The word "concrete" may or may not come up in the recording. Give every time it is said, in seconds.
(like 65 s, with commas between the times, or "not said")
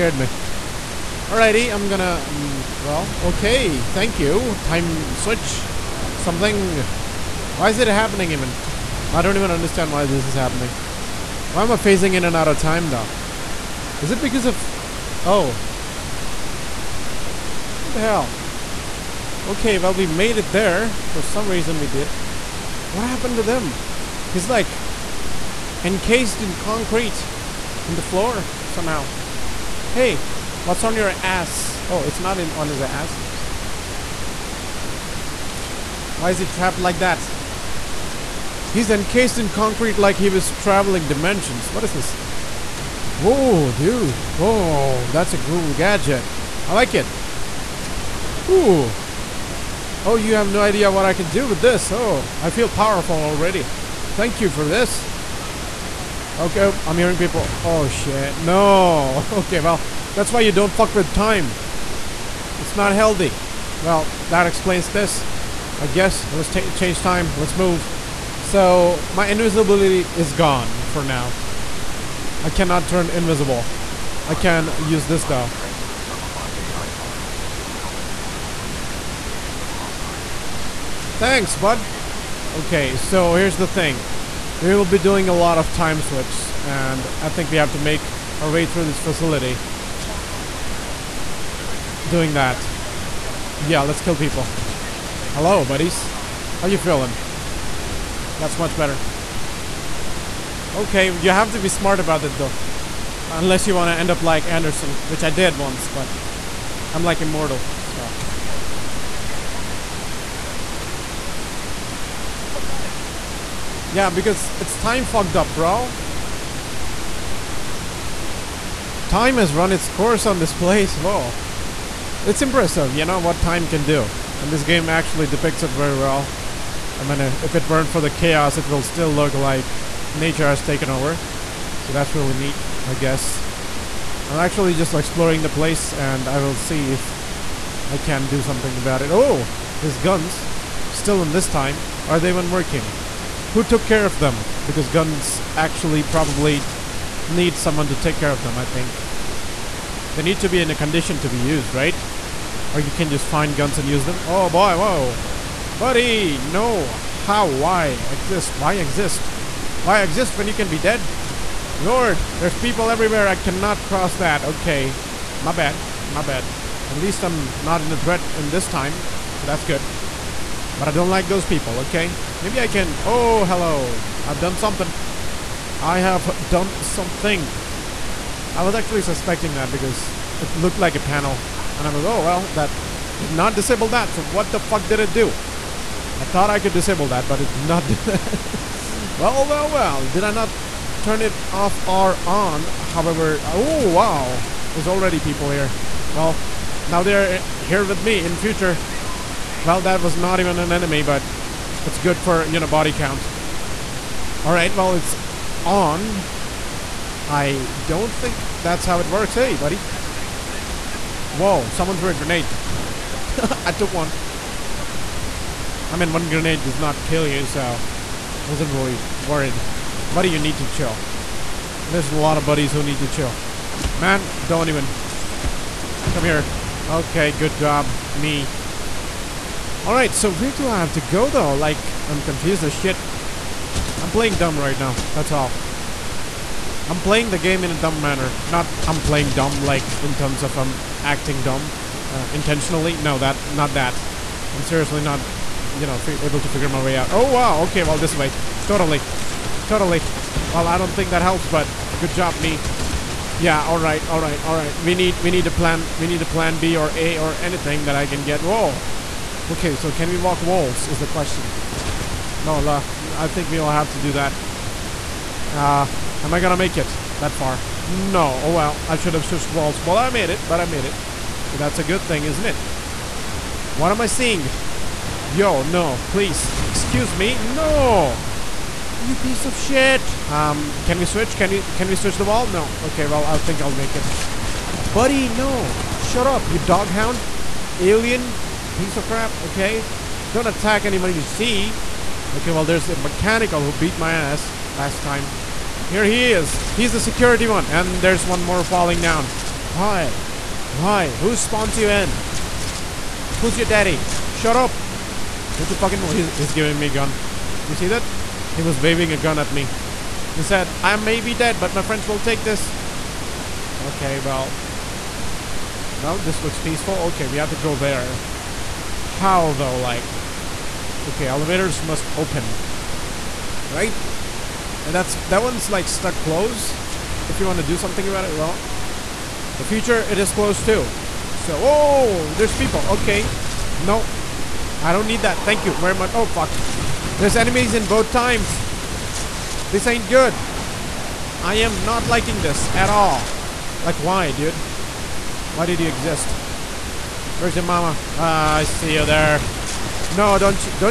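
26 s, 39 s.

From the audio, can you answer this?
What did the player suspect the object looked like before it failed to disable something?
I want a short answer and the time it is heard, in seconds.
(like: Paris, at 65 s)
a panel, at 180 s.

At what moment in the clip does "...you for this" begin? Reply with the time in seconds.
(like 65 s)
54 s.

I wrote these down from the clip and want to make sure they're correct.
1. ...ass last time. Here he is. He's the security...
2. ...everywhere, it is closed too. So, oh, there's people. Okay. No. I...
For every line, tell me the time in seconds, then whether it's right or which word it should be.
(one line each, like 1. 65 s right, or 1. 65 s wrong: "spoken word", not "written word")
1. 294 s right
2. 329 s wrong: "future", not "everywhere".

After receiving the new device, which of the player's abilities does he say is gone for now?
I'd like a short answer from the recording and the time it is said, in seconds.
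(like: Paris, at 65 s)
invisibility, at 69 s.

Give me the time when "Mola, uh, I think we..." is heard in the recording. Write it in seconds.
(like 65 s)
262 s.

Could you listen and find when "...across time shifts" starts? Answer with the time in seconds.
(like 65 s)
79 s.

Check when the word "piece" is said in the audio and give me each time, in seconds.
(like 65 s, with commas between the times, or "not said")
279 s, 288 s.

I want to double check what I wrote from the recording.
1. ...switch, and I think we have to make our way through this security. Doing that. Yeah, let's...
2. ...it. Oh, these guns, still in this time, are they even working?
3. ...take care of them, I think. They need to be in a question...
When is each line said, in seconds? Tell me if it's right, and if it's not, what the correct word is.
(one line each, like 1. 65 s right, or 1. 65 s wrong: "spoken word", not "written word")
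1. 85 s wrong: "facility", not "security"
2. 139 s right
3. 147 s wrong: "condition", not "question".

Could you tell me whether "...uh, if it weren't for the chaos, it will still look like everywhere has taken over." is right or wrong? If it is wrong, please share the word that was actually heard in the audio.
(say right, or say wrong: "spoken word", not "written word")
wrong: "nature", not "everywhere".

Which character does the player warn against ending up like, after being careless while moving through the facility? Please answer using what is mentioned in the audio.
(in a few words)
Anderson.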